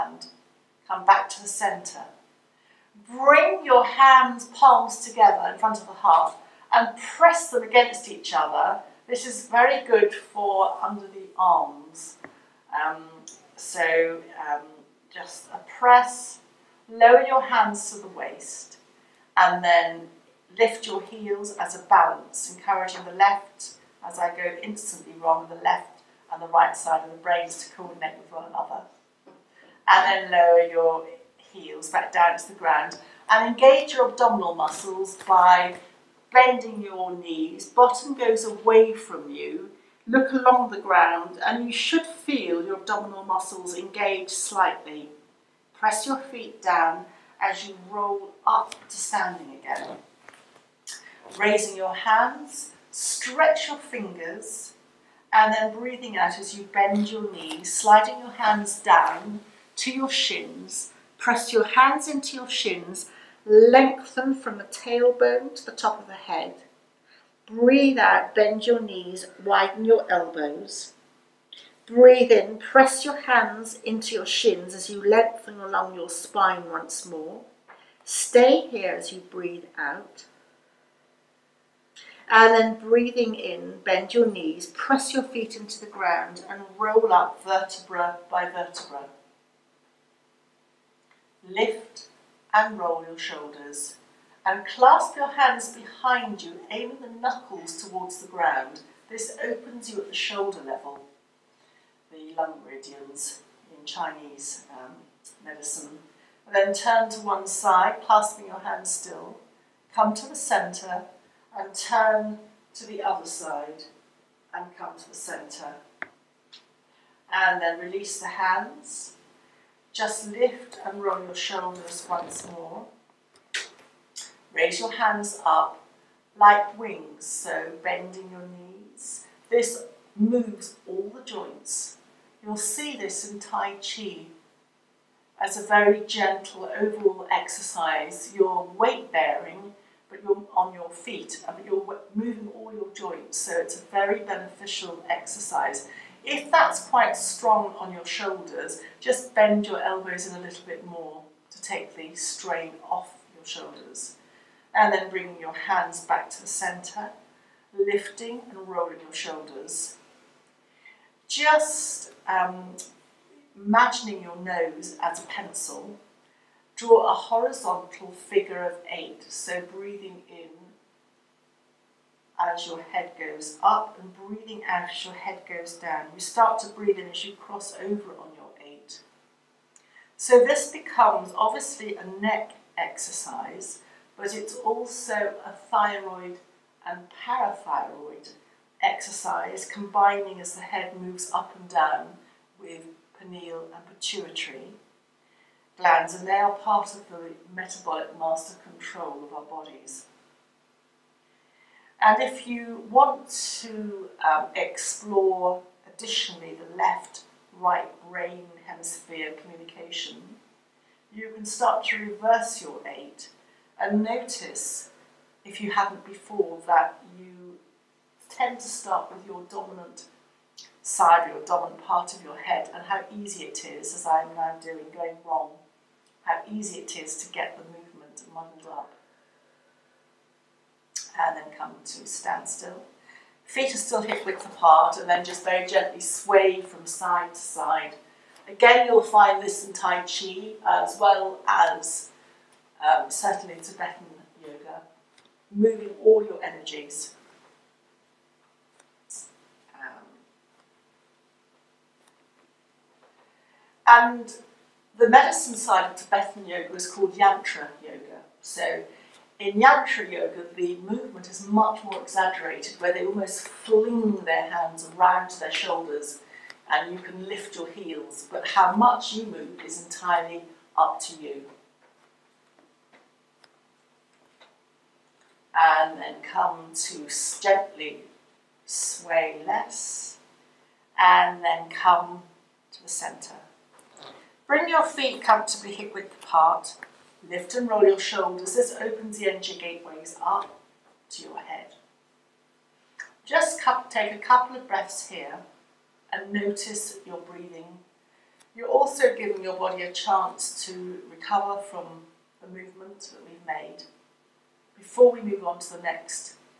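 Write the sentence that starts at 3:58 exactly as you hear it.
Again, you'll find this in Tai Chi as well as um, certainly Tibetan yoga, moving all your energies.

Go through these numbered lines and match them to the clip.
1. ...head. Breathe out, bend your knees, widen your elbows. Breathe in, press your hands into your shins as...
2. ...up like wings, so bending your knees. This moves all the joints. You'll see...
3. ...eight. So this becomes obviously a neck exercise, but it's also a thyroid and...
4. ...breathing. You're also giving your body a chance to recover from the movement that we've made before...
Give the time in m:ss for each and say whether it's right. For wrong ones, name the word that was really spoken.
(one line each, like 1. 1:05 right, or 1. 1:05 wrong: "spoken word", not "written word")
1. 1:06 right
2. 2:05 right
3. 2:58 right
4. 4:57 right.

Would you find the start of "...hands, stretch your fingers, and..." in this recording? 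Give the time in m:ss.
0:51.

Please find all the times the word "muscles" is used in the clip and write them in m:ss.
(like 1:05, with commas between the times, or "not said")
0:34, 0:43.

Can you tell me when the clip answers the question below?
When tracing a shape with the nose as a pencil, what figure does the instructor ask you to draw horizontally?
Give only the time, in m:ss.
2:48.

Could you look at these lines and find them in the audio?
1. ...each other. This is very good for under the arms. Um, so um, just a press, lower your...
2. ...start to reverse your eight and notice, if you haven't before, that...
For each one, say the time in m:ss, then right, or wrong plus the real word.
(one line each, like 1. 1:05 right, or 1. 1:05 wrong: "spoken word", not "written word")
1. 0:08 right
2. 3:31 right.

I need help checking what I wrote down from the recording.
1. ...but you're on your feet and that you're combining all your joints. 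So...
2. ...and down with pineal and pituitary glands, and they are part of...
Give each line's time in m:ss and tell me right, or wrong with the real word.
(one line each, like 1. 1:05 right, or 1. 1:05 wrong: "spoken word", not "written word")
1. 2:20 wrong: "moving", not "combining"
2. 3:11 right.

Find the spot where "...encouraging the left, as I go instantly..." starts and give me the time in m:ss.
0:22.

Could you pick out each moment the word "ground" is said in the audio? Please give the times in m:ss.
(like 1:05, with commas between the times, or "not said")
0:32, 0:40, 1:25, 1:38.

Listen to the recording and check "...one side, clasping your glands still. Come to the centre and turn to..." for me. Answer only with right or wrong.
wrong.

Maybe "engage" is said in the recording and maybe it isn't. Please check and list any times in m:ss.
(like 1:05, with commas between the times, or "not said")
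0:33, 0:43.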